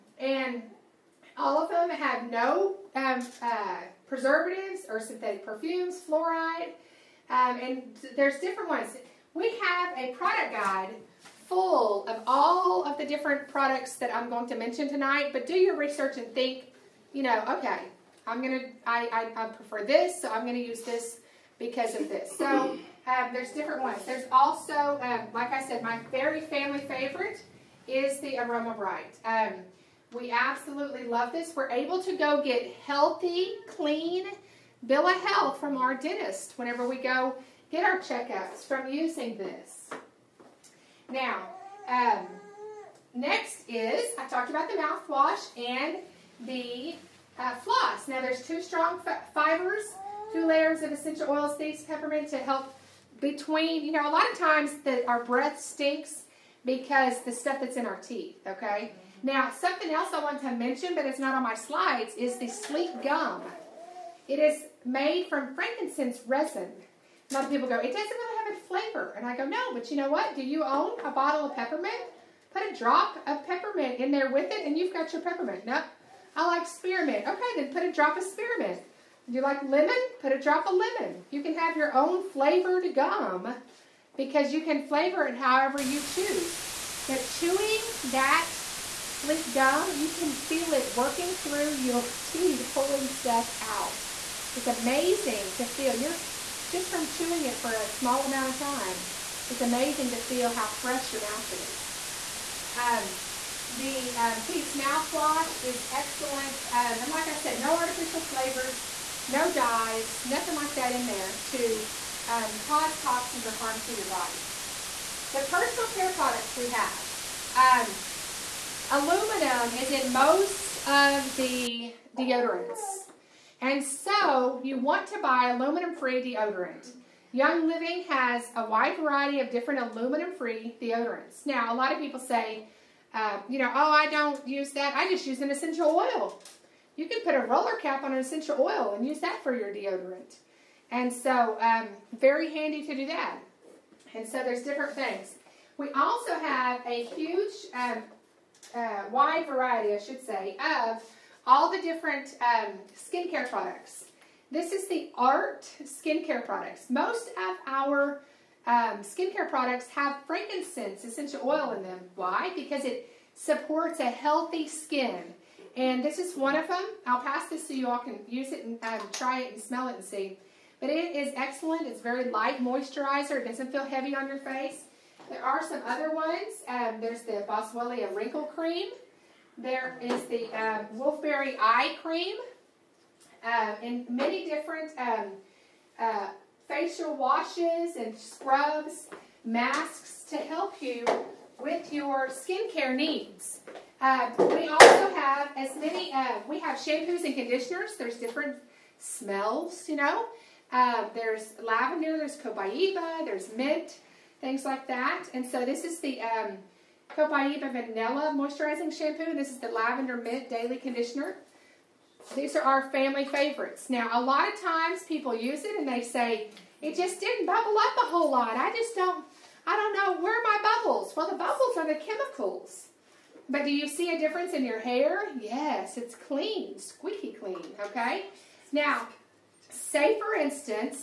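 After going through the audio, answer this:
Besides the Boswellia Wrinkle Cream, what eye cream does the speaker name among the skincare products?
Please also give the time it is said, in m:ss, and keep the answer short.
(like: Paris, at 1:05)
Wolfberry Eye Cream, at 3:00.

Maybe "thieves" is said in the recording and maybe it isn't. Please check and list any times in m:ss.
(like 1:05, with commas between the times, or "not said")
0:51, 1:44.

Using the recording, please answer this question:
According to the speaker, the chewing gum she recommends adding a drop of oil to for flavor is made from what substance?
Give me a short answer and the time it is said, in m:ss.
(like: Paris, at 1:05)
frankincense resin, at 1:05.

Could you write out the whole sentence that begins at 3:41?
Well, the bubbles are the chemicals.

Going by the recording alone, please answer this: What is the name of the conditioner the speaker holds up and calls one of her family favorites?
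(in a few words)
Lavender Mint Daily Conditioner.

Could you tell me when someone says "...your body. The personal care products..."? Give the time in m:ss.
1:53.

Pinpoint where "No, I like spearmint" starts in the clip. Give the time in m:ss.
1:15.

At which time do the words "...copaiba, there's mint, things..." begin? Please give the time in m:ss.
3:22.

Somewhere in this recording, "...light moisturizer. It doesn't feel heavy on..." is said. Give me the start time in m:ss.
2:52.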